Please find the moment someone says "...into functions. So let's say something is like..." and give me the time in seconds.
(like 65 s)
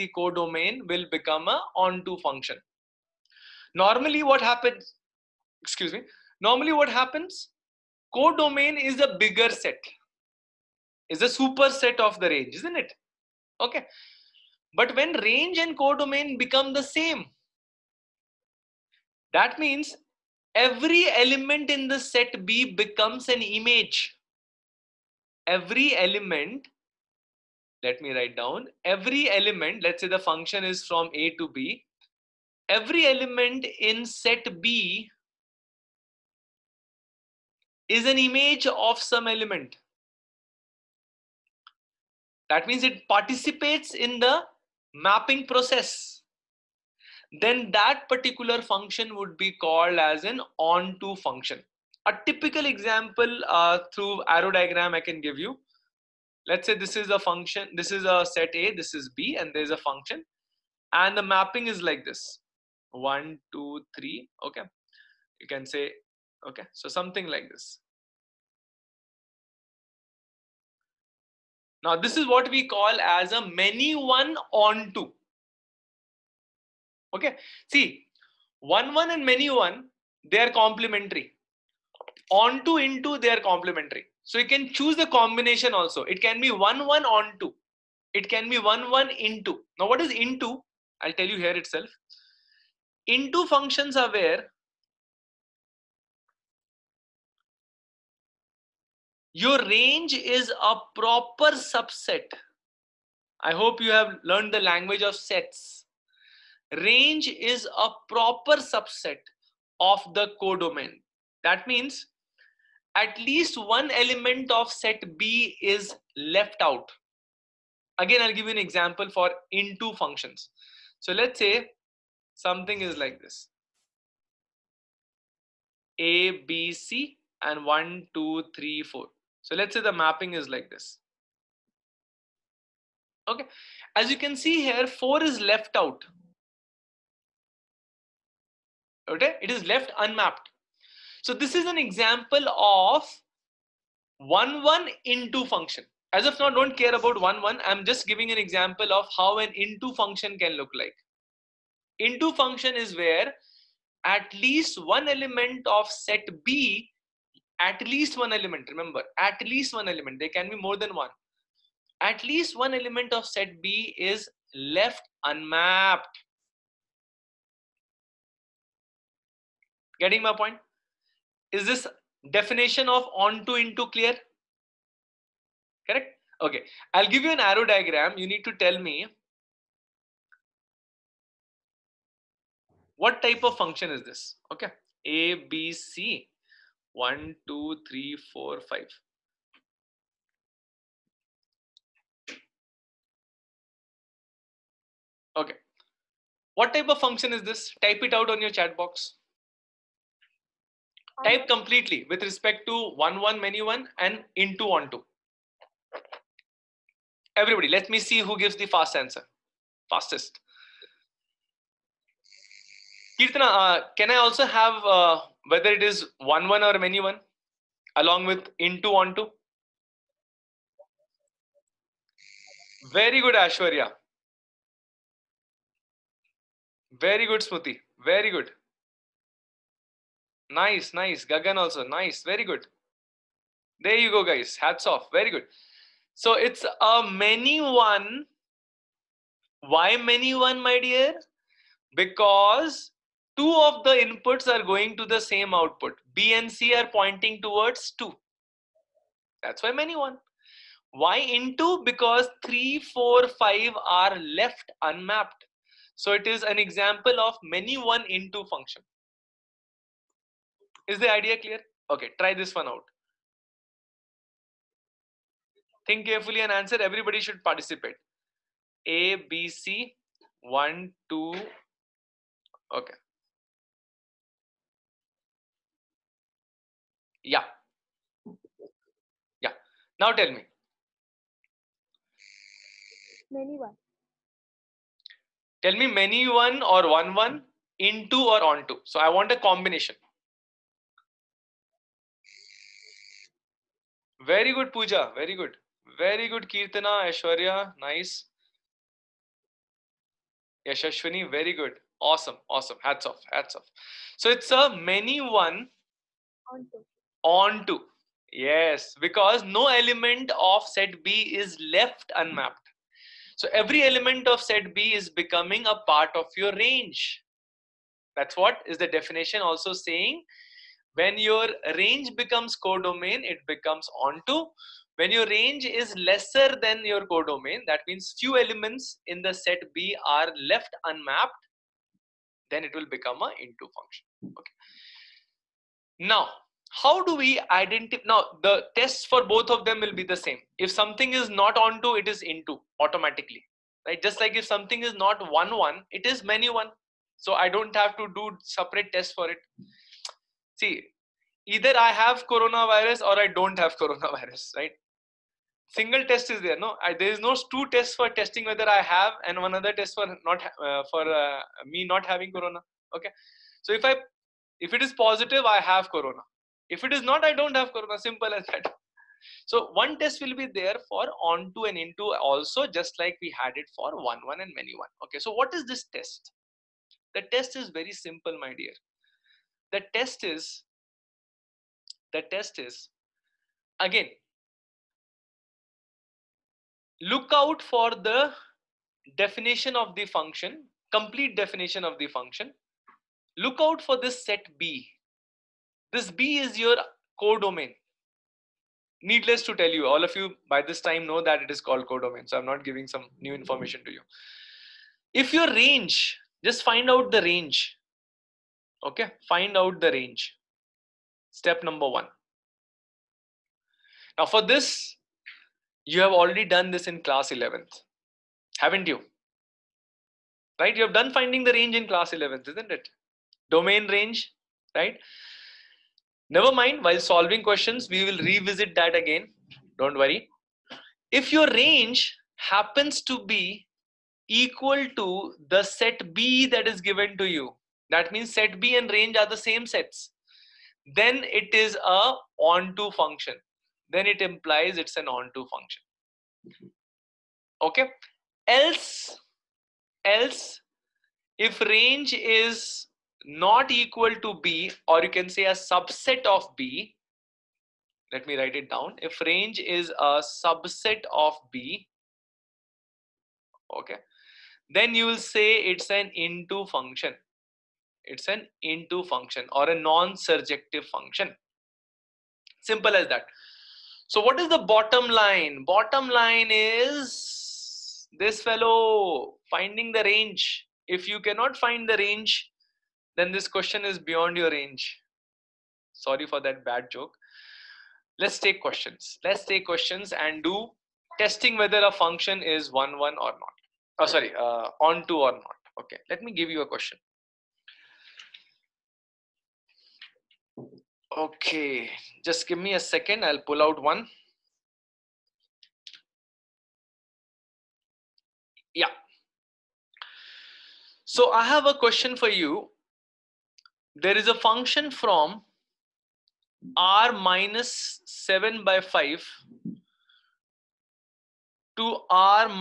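119 s.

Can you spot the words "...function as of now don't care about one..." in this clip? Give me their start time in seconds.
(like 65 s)
145 s.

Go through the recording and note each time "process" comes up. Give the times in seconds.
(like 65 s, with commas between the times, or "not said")
45 s.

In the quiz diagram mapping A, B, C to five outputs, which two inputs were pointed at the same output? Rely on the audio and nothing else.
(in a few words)
B and C.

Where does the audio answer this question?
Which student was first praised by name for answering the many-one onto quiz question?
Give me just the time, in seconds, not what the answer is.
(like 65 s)
294 s.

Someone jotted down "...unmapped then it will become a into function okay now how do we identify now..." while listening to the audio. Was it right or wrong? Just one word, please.
right.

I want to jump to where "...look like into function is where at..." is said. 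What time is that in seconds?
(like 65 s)
150 s.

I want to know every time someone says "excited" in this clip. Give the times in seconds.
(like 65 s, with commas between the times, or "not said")
not said.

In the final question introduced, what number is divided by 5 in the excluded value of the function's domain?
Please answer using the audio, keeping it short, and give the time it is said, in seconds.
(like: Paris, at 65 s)
7, at 518 s.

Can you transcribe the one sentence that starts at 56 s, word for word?
Let's say this is a function, this is a set A, this is B, and there's a function.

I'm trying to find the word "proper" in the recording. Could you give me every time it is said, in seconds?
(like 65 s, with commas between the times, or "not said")
100 s, 108 s.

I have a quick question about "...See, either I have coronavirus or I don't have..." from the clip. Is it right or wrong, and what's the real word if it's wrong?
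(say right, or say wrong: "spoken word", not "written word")
right.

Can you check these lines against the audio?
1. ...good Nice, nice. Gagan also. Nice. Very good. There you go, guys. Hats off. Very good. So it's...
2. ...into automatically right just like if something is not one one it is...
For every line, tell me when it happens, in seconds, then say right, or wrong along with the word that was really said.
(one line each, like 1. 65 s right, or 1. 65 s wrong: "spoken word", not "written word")
1. 228 s right
2. 342 s right.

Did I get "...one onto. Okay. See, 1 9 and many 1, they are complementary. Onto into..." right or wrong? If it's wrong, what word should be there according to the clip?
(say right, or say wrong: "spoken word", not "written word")
wrong: "1", not "9".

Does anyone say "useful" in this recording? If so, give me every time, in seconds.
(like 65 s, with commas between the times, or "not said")
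not said.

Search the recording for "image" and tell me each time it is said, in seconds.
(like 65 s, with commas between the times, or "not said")
23 s, 38 s.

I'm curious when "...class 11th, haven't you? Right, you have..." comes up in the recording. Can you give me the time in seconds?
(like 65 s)
417 s.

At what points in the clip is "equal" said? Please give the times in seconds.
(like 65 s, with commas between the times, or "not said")
434 s, 453 s.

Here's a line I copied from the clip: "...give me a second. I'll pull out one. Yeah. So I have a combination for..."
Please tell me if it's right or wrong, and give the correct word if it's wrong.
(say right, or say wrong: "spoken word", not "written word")
wrong: "question", not "combination".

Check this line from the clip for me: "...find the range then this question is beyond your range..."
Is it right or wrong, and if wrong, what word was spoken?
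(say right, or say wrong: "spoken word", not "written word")
right.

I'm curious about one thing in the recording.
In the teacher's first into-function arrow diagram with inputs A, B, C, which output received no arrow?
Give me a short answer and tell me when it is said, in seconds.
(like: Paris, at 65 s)
4, at 134 s.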